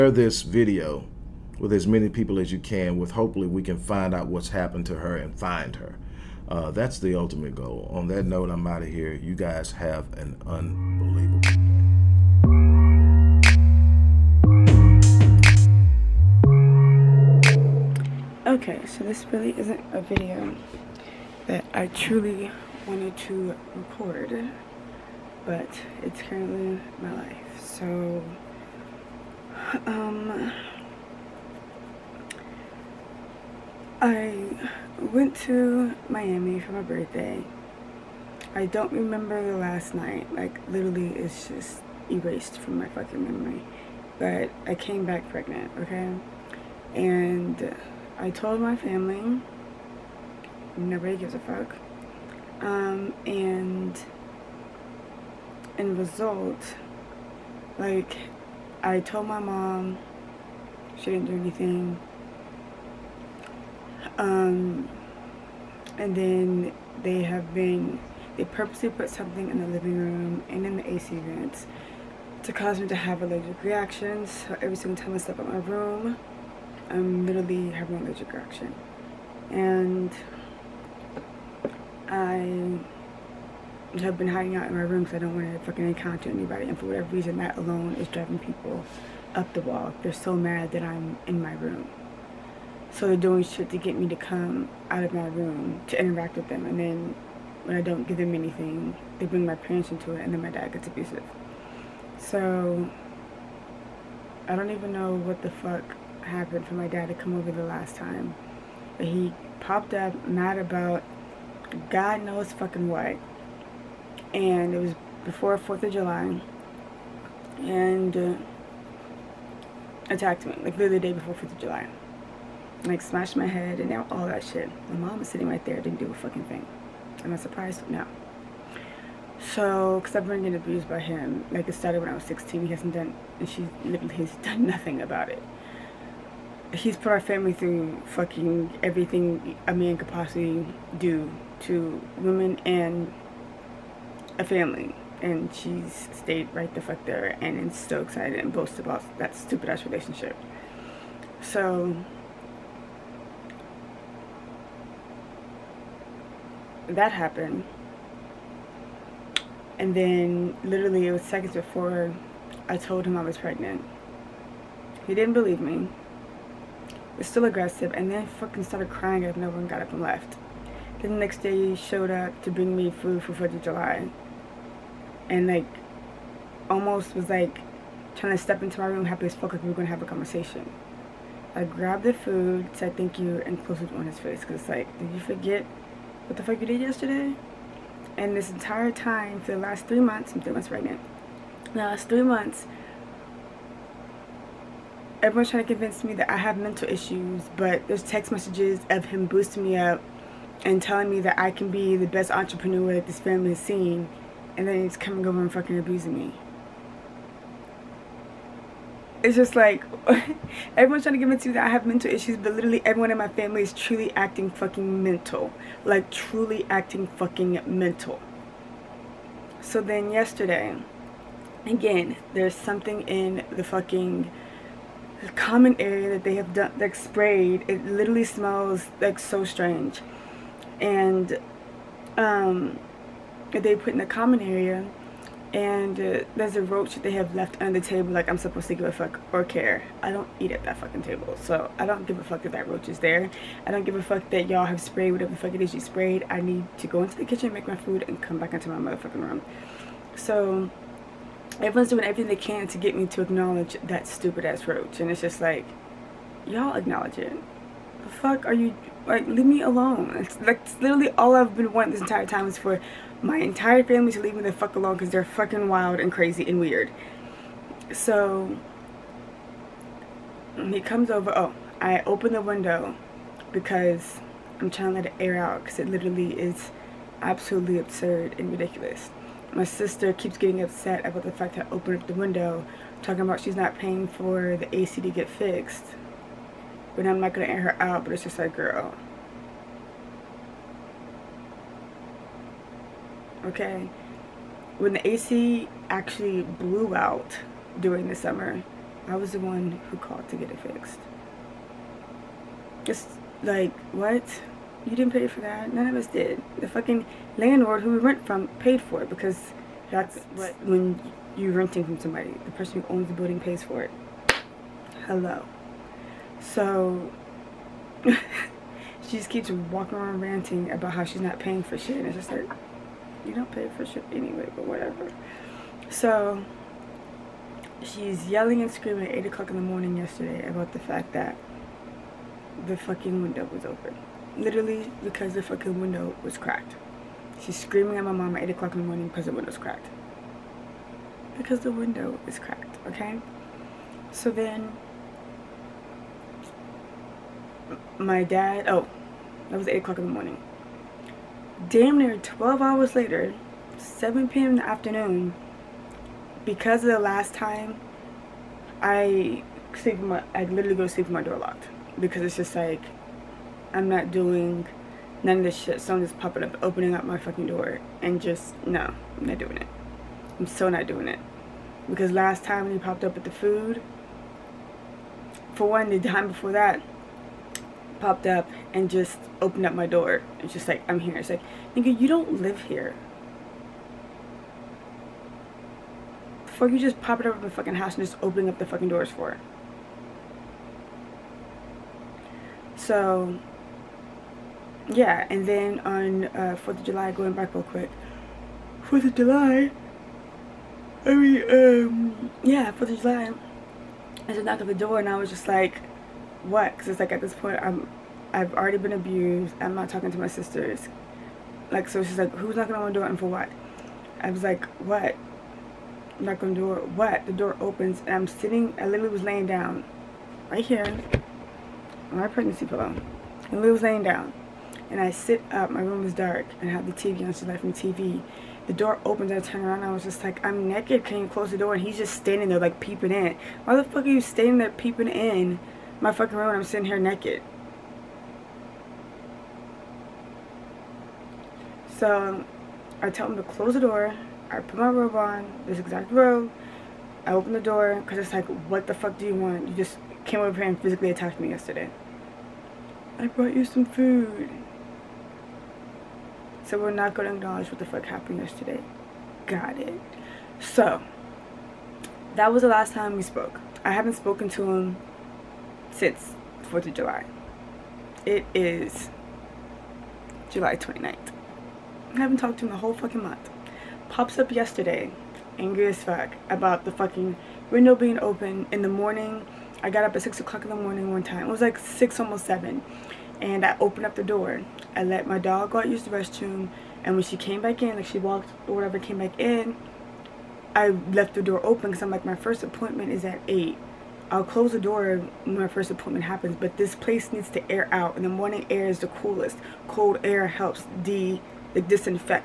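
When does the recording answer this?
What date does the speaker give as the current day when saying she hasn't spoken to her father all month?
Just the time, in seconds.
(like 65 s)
470 s.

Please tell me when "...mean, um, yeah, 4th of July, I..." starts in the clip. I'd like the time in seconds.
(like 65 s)
401 s.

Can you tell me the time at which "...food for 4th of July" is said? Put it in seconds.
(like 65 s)
172 s.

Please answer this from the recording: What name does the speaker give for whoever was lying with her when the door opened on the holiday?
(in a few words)
Lily.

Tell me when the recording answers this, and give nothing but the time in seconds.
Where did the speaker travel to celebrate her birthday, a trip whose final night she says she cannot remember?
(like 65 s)
36 s.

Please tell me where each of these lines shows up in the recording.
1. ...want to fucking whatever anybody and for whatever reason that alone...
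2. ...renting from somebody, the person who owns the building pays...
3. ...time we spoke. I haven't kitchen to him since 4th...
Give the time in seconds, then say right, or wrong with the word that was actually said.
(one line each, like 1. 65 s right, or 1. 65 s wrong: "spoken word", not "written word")
1. 85 s wrong: "encounter", not "whatever"
2. 311 s right
3. 462 s wrong: "spoken", not "kitchen".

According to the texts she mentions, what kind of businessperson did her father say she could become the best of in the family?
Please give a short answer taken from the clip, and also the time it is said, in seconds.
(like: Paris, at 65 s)
entrepreneur, at 202 s.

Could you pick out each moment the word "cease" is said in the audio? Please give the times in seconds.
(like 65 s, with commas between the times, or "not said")
not said.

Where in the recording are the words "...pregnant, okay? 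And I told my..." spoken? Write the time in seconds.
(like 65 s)
45 s.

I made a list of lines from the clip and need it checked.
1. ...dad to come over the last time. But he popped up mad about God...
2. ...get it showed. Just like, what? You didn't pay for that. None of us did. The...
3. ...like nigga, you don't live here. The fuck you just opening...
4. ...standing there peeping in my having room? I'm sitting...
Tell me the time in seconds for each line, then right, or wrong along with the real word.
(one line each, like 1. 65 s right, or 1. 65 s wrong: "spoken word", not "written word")
1. 106 s right
2. 300 s wrong: "fixed", not "showed"
3. 381 s wrong: "popping", not "opening"
4. 434 s wrong: "fucking", not "having".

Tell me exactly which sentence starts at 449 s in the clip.
You just came over here and physically attacked me yesterday.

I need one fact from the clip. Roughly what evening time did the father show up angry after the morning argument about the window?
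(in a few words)
7 p.m.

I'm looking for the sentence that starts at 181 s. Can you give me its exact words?
I grabbed the food, said thank you, and closed it on his face.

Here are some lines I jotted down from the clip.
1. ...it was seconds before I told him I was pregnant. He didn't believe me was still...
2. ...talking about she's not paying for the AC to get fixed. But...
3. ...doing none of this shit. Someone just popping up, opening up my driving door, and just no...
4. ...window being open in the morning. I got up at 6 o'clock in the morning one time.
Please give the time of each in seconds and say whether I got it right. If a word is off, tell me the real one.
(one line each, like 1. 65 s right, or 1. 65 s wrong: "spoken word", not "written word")
1. 161 s right
2. 283 s right
3. 364 s wrong: "fucking", not "driving"
4. 477 s right.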